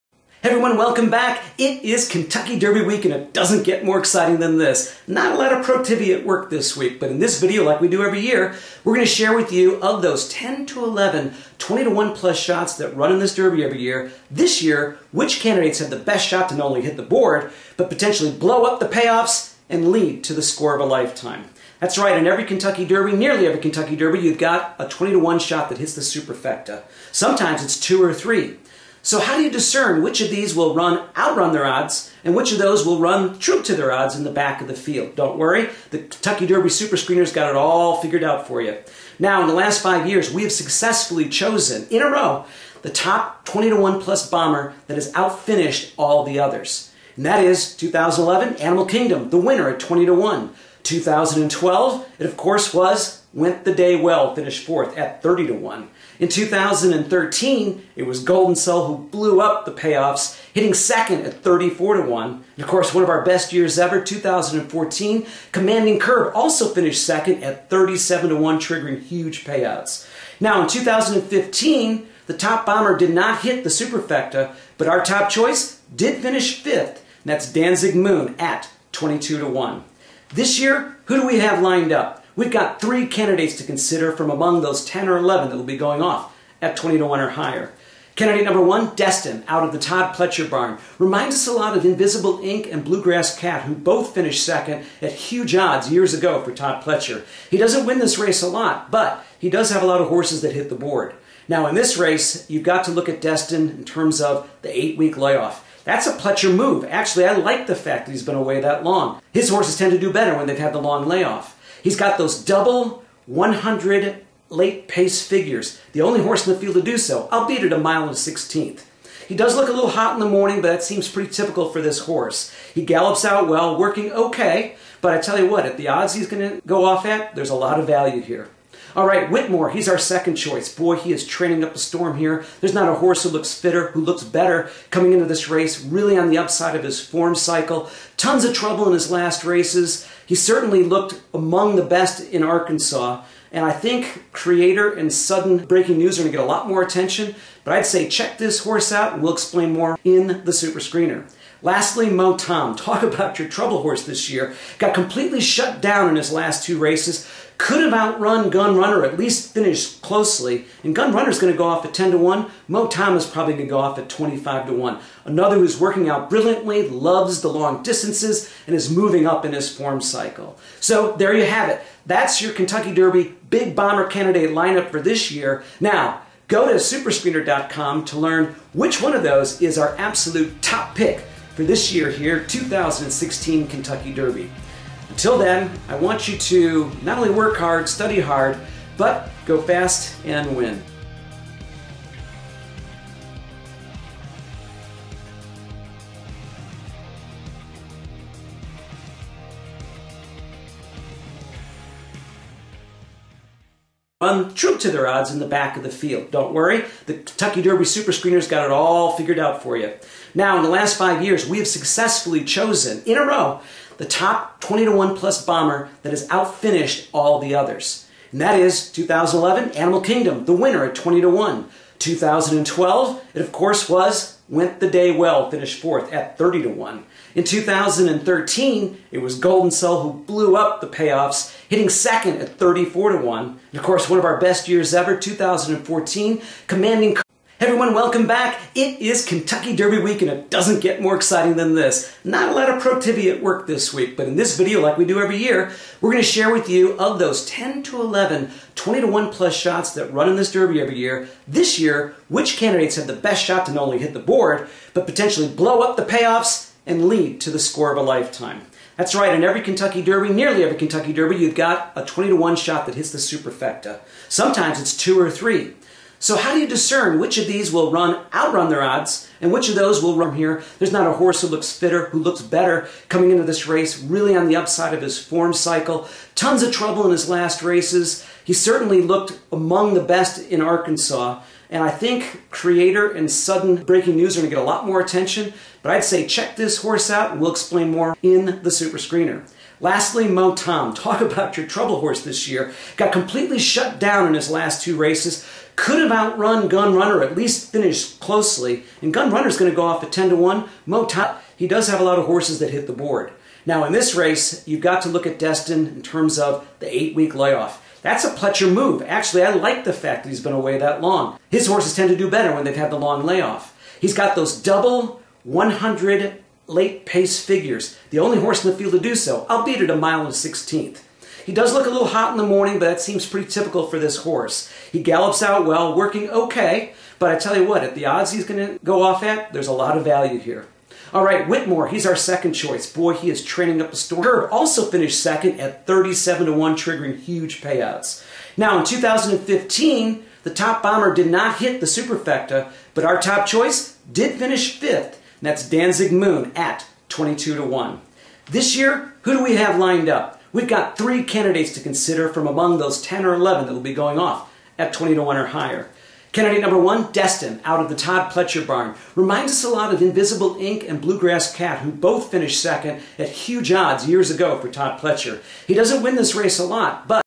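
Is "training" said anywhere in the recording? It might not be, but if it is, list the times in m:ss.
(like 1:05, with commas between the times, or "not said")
2:11, 5:33.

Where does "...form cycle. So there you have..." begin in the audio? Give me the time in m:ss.
2:49.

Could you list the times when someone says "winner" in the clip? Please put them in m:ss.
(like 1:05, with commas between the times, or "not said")
0:49, 3:40.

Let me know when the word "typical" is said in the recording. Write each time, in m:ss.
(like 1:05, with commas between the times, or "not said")
2:01, 5:23.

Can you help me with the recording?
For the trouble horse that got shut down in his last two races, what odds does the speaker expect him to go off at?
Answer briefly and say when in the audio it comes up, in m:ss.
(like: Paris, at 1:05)
25 to 1, at 2:44.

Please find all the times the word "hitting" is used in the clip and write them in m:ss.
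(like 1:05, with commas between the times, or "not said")
1:00, 3:51.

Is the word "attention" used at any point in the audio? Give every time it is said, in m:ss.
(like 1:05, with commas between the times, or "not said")
2:26, 4:45.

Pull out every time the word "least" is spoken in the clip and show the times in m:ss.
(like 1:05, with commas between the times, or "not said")
2:39, 4:57.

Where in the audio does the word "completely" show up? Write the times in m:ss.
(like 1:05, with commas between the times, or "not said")
2:34, 4:53.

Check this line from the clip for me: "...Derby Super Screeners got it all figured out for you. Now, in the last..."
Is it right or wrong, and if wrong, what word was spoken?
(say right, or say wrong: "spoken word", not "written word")
right.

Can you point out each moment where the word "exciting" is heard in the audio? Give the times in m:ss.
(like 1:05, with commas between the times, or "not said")
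0:03, 4:01.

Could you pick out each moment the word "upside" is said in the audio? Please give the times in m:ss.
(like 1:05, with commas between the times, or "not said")
2:16, 4:34.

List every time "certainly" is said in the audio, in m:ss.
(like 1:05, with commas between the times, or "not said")
2:20, 4:38.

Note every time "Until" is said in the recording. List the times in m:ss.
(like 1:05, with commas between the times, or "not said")
3:05.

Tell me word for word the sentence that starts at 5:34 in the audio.
Herb also finished second at 37 to 1, triggering huge payouts.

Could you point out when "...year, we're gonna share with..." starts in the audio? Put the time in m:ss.
0:08.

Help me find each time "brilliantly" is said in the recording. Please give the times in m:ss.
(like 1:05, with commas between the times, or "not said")
2:46.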